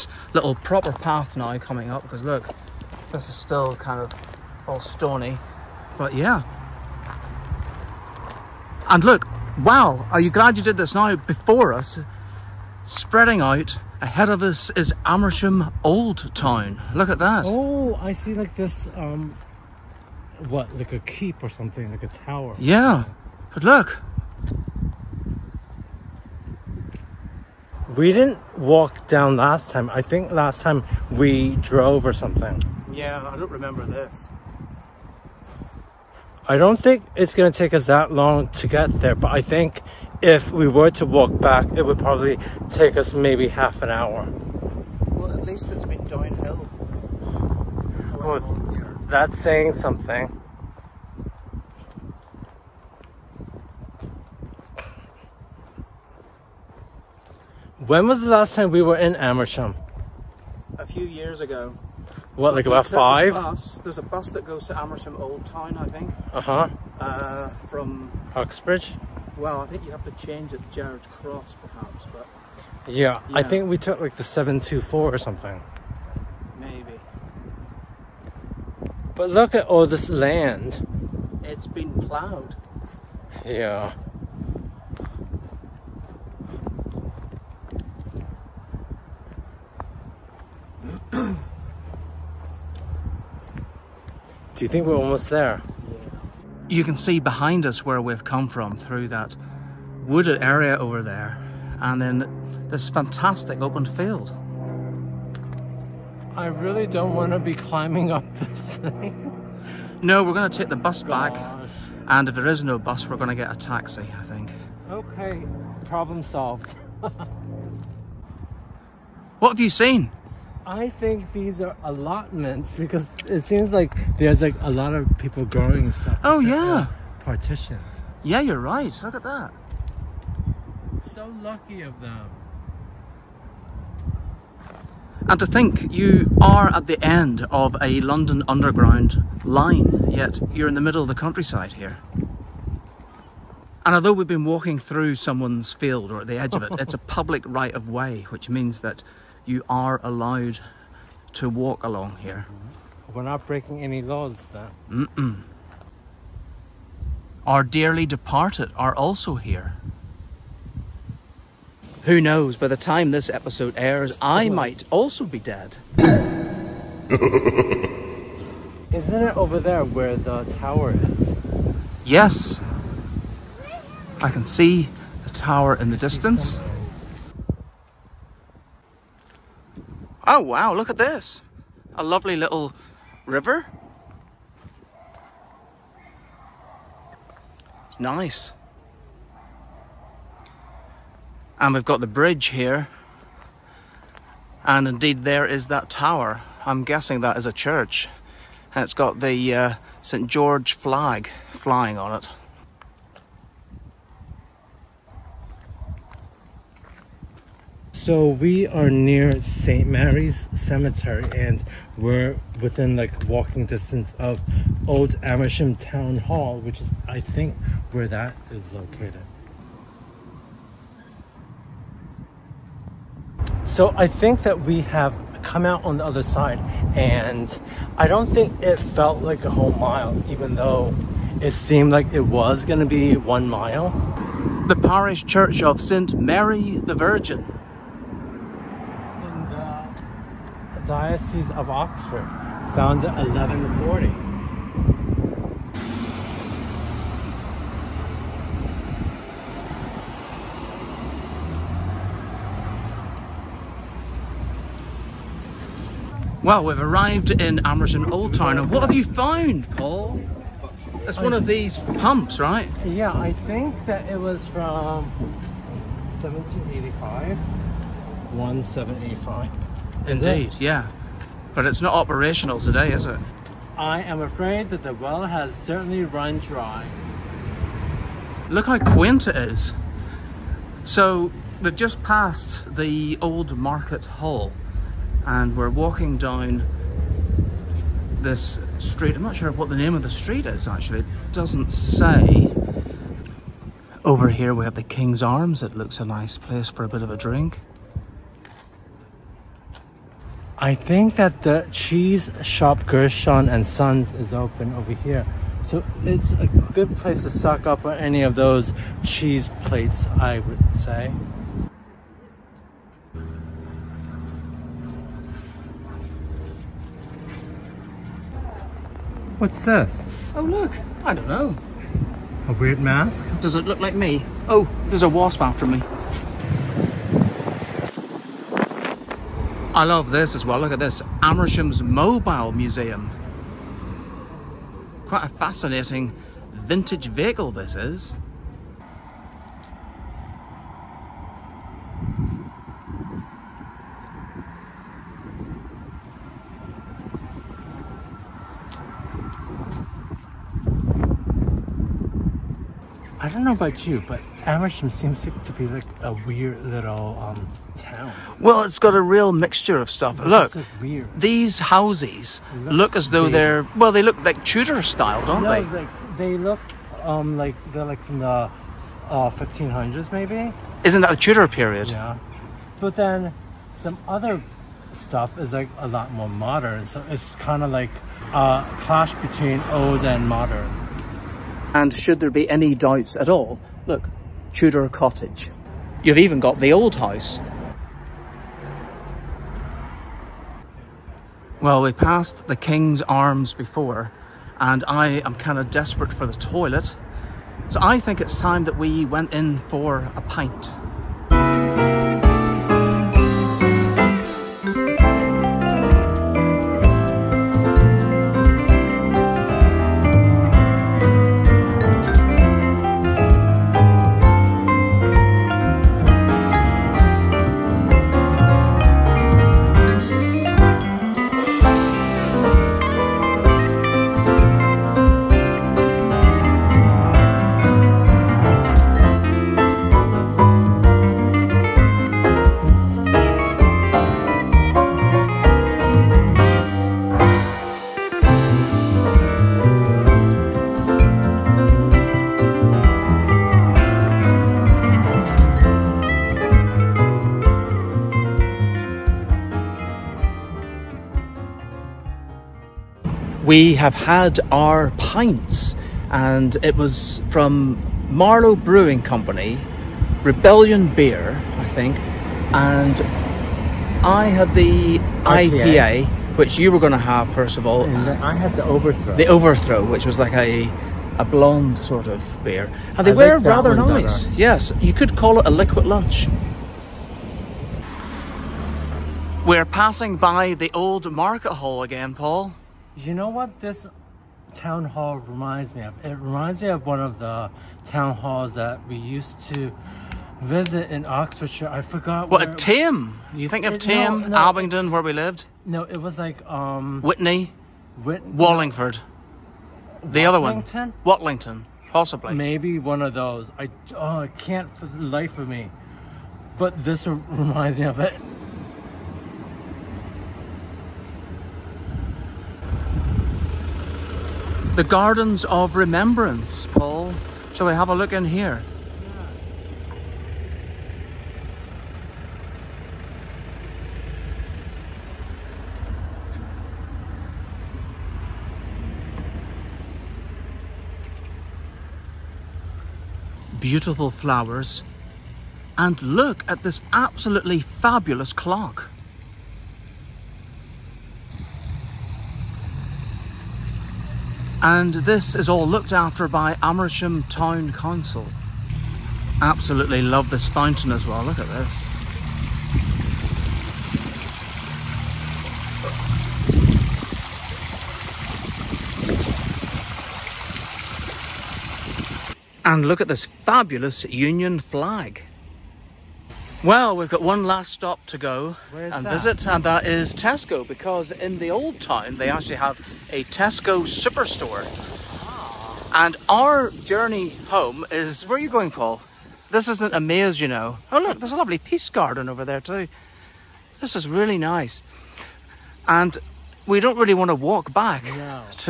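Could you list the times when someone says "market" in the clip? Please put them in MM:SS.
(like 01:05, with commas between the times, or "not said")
04:43, 08:01.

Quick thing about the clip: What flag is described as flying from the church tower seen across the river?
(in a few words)
St. George flag.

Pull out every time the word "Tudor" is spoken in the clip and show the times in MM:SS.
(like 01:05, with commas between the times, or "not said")
06:04, 06:11, 06:24.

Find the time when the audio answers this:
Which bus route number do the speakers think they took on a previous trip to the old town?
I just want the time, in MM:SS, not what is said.
01:14.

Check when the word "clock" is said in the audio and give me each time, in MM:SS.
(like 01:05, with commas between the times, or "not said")
08:58.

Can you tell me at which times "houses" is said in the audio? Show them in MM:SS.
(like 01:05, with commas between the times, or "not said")
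06:01, 06:26.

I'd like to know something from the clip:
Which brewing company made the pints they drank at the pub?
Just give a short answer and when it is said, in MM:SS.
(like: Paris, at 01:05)
Marlow Brewing Company, at 07:38.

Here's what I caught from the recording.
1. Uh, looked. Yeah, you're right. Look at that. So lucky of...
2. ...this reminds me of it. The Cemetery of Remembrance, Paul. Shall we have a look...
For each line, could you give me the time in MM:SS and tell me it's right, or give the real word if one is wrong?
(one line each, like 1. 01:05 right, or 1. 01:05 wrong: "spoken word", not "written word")
1. 02:06 wrong: "partitioned", not "looked"
2. 08:26 wrong: "Gardens", not "Cemetery".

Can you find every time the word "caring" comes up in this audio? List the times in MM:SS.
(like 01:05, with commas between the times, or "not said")
not said.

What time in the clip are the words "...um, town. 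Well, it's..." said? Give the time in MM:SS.
05:57.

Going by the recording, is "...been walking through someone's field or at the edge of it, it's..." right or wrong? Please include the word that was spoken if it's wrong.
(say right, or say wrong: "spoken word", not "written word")
right.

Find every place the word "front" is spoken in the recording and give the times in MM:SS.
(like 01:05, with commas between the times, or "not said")
not said.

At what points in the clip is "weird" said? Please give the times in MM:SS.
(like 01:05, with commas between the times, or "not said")
05:22, 05:56.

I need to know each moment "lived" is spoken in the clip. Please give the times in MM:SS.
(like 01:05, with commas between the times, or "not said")
08:15.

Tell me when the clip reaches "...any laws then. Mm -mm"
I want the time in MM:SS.
02:33.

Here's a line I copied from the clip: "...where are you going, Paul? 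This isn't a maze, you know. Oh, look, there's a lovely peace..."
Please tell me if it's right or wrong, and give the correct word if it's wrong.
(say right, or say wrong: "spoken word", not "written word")
right.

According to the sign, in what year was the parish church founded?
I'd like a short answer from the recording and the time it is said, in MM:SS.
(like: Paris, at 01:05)
1140, at 04:03.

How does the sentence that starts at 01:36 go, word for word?
you can see behind us where we've come from through that wooded area over there and then this fantastic open field.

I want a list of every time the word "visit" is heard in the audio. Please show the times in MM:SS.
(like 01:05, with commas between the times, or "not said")
08:10, 09:29.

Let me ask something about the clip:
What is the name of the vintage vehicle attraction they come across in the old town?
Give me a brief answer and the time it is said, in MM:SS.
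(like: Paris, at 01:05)
Amersham's Mobile Museum, at 05:31.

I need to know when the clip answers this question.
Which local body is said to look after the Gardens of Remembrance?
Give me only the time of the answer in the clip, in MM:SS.
09:06.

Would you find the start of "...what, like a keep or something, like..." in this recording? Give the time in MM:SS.
00:20.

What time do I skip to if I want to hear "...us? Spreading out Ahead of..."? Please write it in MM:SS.
00:11.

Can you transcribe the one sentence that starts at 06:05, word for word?
Like, they look um, like they're like from the uh, 1500s, maybe.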